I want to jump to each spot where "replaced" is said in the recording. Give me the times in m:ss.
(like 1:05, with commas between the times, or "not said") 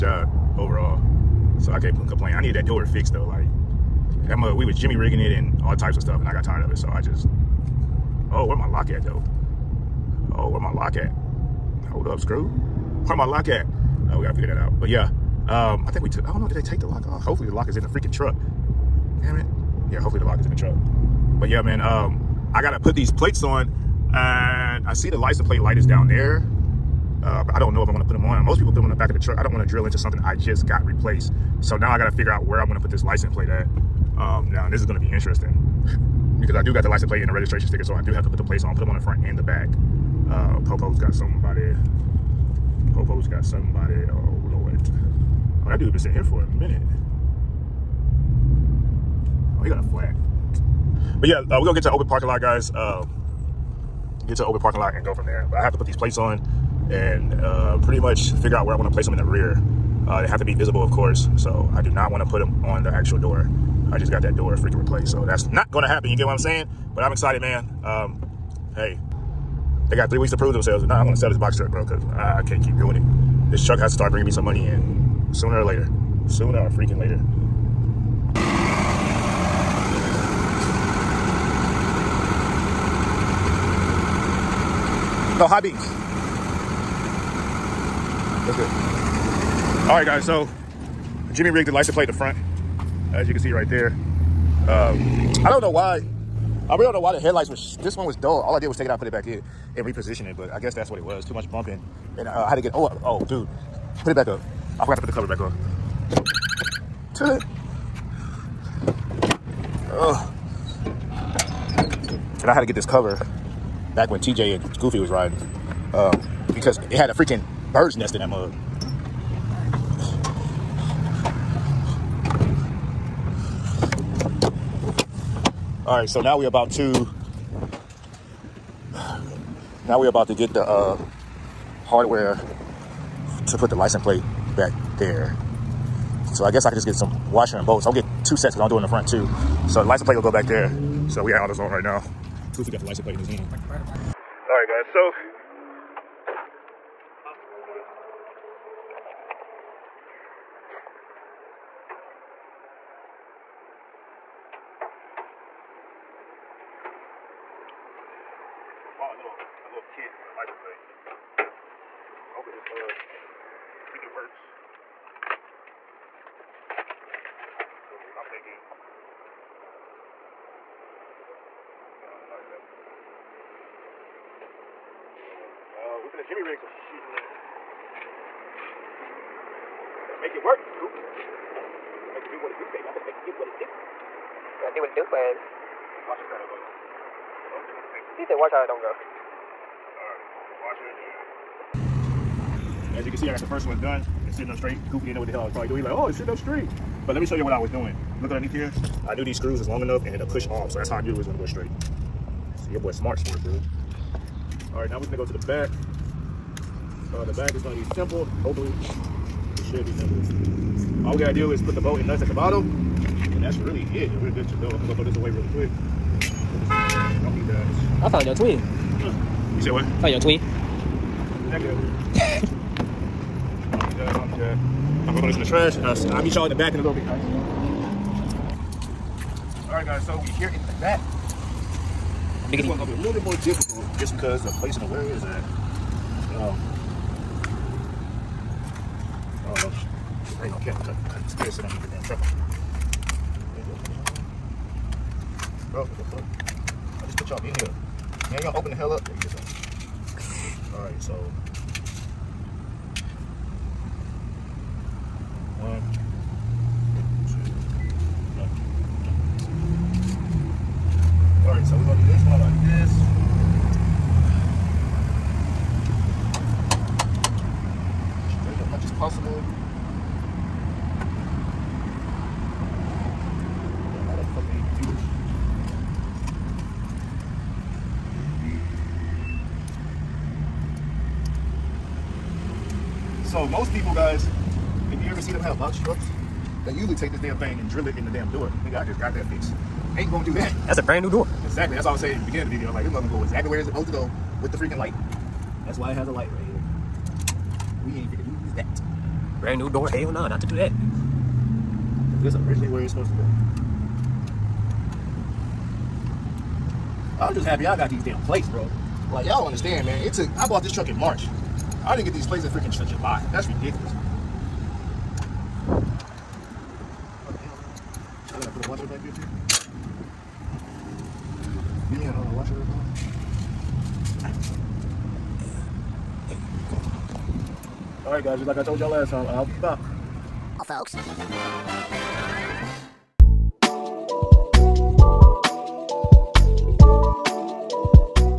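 0:30, 1:04.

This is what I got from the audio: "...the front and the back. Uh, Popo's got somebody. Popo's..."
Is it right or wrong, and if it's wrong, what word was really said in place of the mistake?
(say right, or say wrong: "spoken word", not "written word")
right.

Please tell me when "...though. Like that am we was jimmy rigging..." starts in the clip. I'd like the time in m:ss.
0:03.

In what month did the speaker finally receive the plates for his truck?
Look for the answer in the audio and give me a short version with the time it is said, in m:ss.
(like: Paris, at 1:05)
July, at 5:12.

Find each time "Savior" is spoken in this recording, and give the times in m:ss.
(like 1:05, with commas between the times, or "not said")
not said.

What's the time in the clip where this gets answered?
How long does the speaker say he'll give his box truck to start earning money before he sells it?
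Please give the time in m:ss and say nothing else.
1:10.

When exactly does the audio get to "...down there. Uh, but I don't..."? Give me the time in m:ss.
0:25.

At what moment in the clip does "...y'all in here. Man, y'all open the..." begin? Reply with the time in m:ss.
4:07.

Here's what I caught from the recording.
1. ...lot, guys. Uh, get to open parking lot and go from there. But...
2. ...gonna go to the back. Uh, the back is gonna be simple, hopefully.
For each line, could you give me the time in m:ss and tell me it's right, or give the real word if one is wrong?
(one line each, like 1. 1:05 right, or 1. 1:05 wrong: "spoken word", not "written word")
1. 0:52 right
2. 3:25 right.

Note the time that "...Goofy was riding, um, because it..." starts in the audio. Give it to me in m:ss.
1:54.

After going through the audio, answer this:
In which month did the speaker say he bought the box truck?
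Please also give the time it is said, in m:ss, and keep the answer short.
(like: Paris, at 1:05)
March, at 5:10.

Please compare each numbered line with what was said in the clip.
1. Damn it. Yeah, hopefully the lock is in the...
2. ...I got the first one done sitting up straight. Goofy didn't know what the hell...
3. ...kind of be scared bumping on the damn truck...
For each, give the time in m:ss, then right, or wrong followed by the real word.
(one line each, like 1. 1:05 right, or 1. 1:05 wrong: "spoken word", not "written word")
1. 0:19 right
2. 3:13 right
3. 4:01 wrong: "sitting", not "bumping".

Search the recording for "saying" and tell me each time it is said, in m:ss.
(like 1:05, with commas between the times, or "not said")
1:06, 4:51.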